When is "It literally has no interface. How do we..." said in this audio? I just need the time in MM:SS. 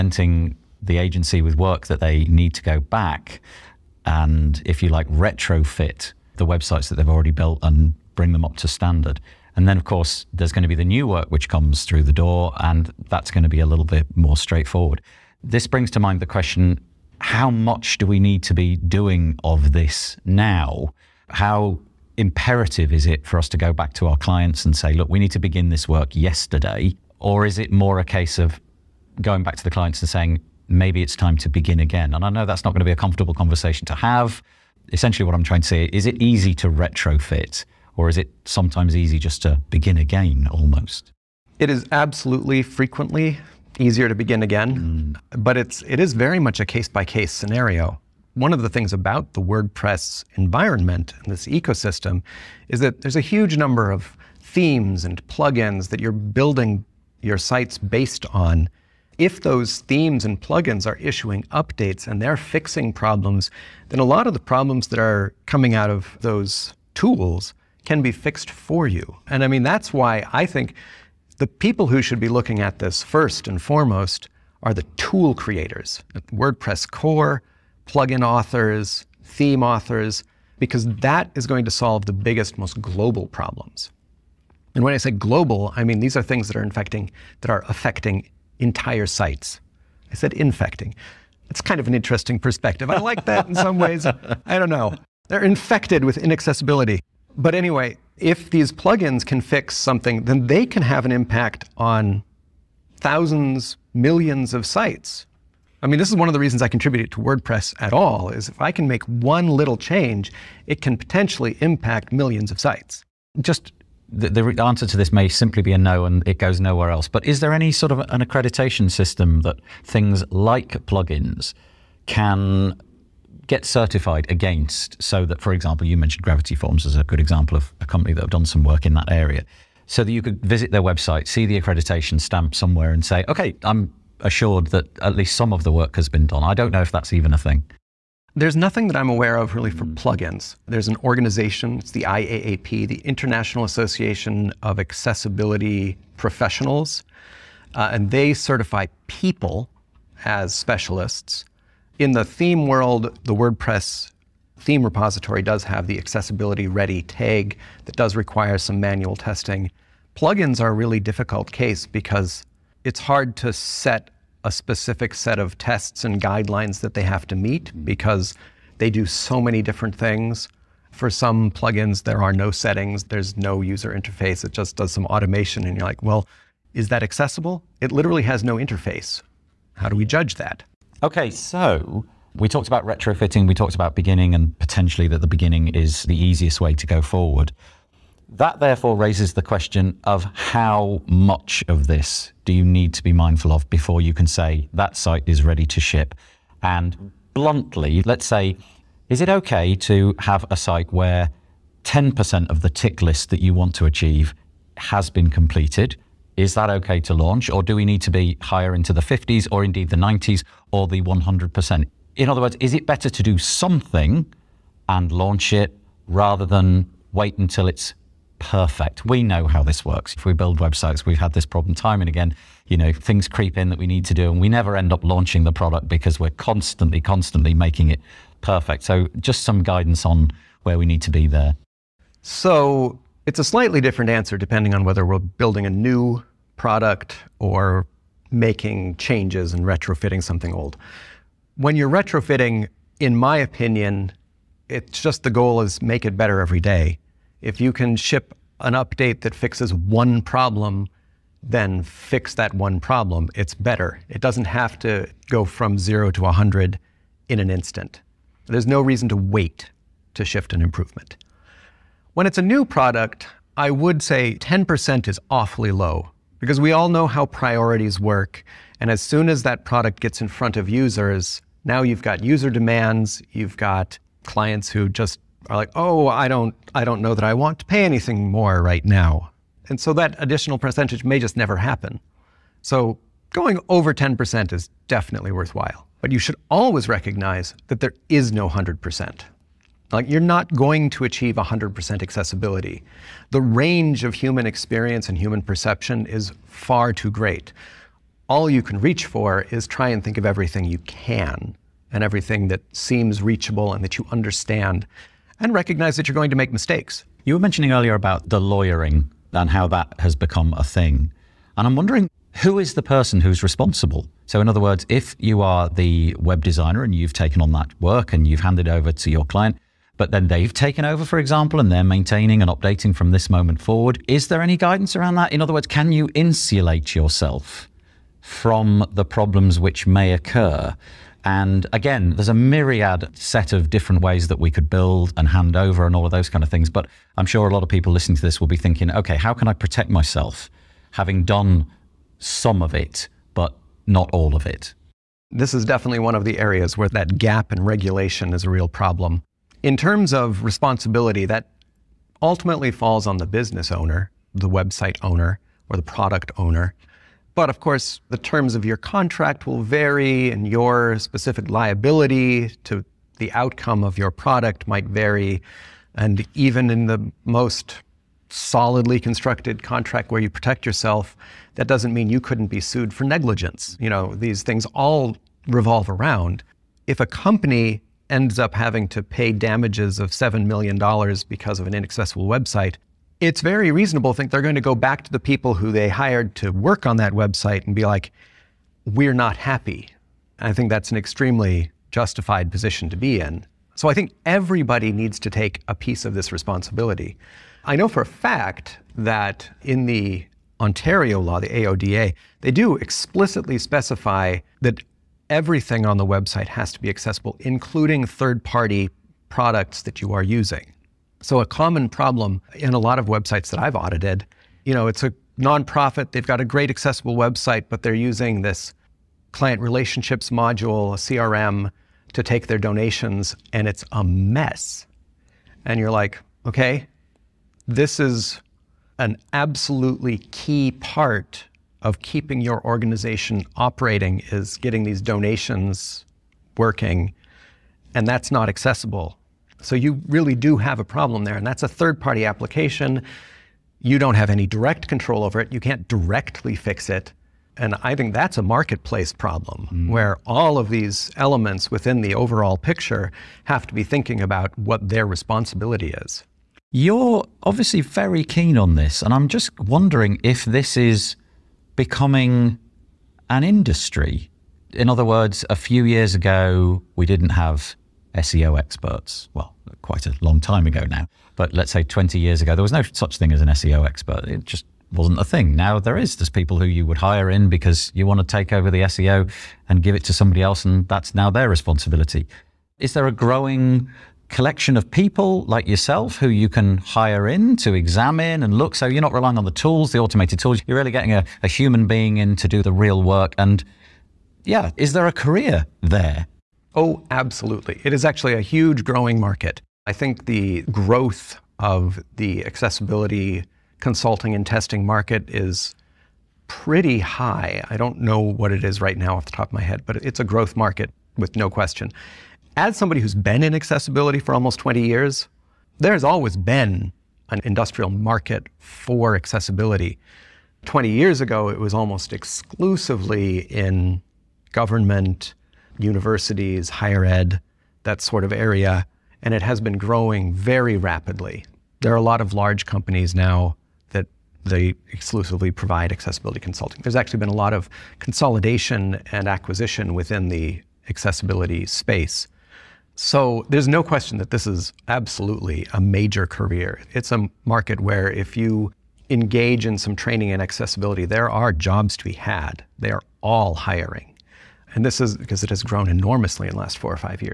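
02:57.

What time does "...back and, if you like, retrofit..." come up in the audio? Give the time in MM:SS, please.
00:02.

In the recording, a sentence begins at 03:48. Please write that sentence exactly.
So, just some guidance on where we need to be there.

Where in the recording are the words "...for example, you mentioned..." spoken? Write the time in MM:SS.
02:05.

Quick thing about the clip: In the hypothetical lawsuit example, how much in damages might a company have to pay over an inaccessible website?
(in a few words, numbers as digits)
$7 million.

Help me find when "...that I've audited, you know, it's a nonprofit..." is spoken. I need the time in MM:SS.
06:53.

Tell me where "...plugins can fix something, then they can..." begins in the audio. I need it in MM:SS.
01:38.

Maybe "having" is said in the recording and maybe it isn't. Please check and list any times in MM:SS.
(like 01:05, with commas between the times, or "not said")
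05:40, 06:18.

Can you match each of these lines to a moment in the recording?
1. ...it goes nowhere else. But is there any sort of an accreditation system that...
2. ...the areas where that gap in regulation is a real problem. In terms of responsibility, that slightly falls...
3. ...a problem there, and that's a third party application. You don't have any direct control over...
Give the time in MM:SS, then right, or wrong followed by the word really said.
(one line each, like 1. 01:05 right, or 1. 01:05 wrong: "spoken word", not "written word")
1. 01:56 right
2. 05:46 wrong: "ultimately", not "slightly"
3. 07:20 right.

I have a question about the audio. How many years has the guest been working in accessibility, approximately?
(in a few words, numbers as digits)
20 years.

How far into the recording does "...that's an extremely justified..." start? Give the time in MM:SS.
06:30.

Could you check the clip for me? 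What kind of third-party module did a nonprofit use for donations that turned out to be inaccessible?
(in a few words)
CRM.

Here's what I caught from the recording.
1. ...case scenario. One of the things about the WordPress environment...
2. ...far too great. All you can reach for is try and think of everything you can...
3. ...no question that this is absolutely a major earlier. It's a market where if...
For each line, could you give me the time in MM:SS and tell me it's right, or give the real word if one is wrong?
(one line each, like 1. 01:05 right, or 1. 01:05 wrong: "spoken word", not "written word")
1. 00:47 right
2. 04:56 right
3. 09:03 wrong: "career", not "earlier".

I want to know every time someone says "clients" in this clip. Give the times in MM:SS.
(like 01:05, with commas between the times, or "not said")
00:24, 00:29, 04:34, 05:19, 06:59.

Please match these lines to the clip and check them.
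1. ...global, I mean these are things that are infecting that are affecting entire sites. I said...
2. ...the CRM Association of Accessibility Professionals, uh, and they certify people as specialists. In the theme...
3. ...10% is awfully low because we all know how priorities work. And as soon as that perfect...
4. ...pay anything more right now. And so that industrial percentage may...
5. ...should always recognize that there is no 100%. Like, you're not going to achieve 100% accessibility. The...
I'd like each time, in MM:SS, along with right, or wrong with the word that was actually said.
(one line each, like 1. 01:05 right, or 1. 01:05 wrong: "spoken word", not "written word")
1. 01:25 right
2. 02:22 wrong: "International", not "CRM"
3. 04:24 wrong: "product", not "perfect"
4. 04:37 wrong: "additional", not "industrial"
5. 04:46 right.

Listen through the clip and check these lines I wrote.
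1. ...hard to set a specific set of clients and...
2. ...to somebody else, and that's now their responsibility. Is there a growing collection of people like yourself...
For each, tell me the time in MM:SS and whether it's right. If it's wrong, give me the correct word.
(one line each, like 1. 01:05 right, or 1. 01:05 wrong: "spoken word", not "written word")
1. 02:42 wrong: "tests", not "clients"
2. 08:00 right.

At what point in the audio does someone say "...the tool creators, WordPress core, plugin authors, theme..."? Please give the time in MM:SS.
01:14.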